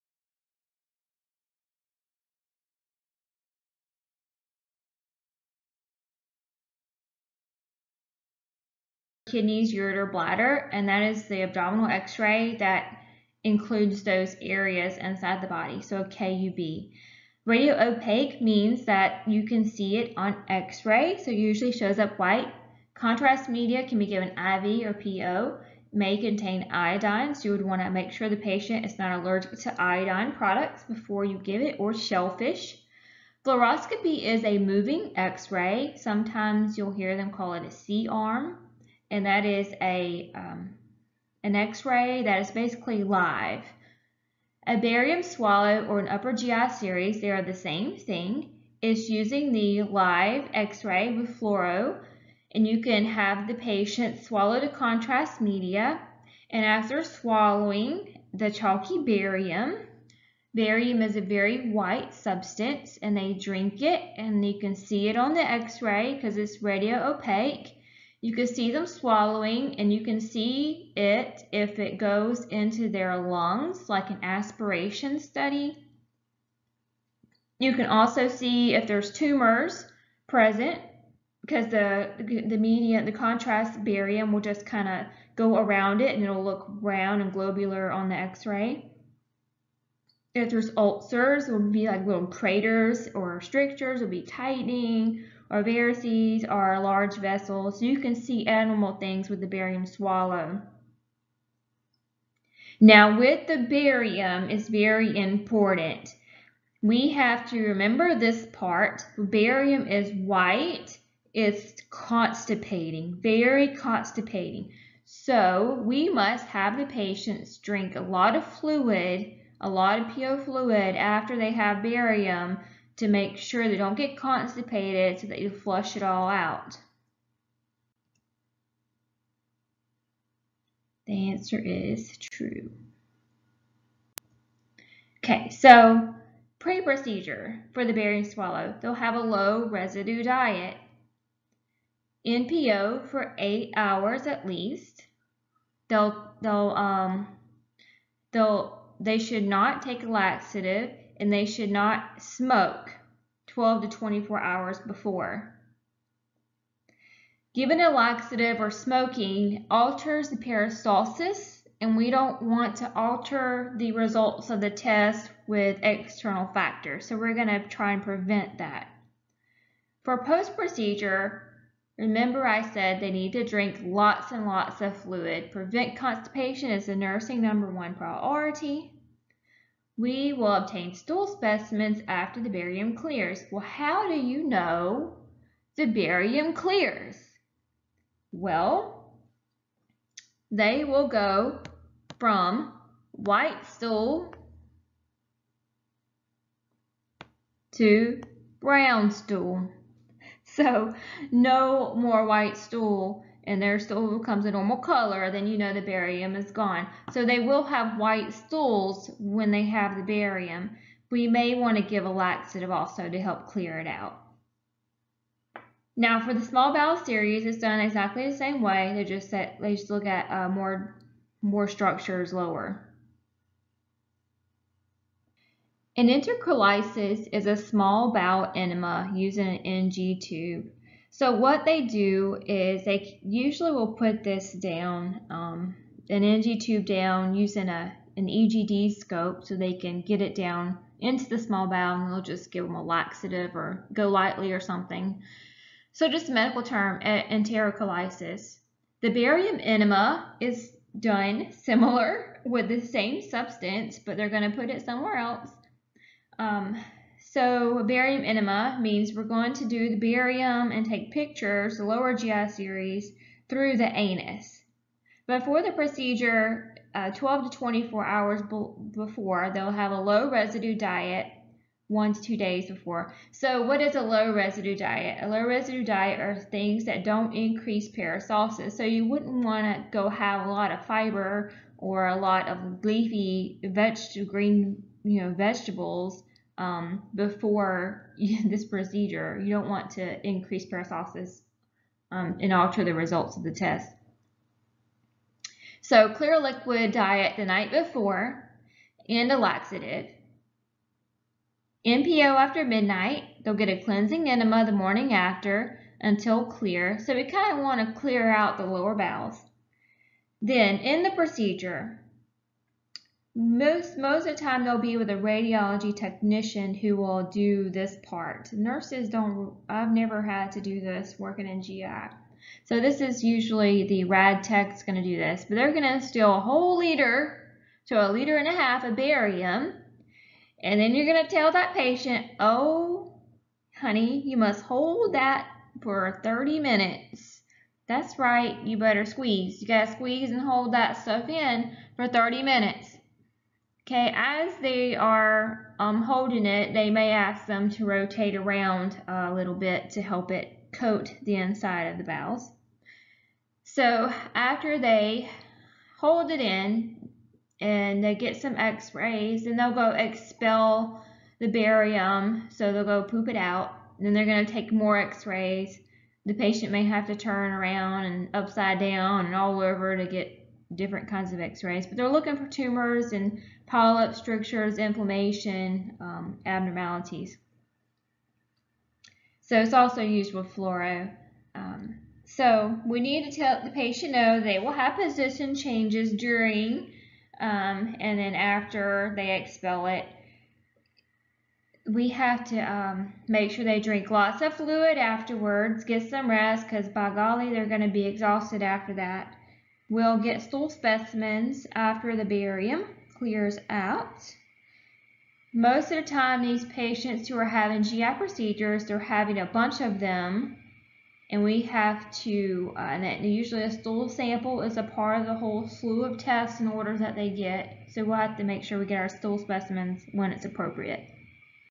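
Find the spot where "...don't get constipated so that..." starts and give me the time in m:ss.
2:03.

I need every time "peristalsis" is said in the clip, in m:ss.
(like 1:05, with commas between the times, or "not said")
2:40, 4:37, 4:50.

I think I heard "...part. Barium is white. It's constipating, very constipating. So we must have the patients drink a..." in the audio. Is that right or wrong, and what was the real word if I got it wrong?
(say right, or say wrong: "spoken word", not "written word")
right.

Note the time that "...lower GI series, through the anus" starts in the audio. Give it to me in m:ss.
4:21.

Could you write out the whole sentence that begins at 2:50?
For post-procedure, remember I said they need to drink lots and lots of fluid.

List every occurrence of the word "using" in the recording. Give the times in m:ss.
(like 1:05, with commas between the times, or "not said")
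0:49, 3:49, 3:57.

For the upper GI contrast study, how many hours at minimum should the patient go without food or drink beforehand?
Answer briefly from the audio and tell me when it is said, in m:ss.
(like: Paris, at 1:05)
8, at 2:23.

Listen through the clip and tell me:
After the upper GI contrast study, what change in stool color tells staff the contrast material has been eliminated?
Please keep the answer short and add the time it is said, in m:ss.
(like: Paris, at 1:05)
brown stool, at 3:18.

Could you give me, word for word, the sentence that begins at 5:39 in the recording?
You got to squeeze and hold that stuff in for 30 minutes.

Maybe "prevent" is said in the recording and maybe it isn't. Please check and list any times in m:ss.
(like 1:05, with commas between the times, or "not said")
2:48, 2:55.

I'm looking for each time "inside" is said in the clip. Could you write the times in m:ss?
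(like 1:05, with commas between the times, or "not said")
0:14, 5:51.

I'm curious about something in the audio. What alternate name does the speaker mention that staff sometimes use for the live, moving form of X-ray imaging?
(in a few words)
C arm.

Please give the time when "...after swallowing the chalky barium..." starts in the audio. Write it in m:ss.
0:56.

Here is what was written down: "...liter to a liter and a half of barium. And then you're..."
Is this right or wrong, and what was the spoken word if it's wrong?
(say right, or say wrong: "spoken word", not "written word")
right.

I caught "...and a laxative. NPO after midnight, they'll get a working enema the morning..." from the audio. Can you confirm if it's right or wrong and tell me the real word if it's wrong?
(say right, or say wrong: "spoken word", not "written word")
wrong: "cleansing", not "working".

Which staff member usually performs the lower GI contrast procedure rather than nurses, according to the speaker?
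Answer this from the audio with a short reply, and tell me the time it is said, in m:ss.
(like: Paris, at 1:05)
radiology technician, at 5:15.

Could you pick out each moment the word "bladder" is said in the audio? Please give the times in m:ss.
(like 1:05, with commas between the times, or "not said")
0:10.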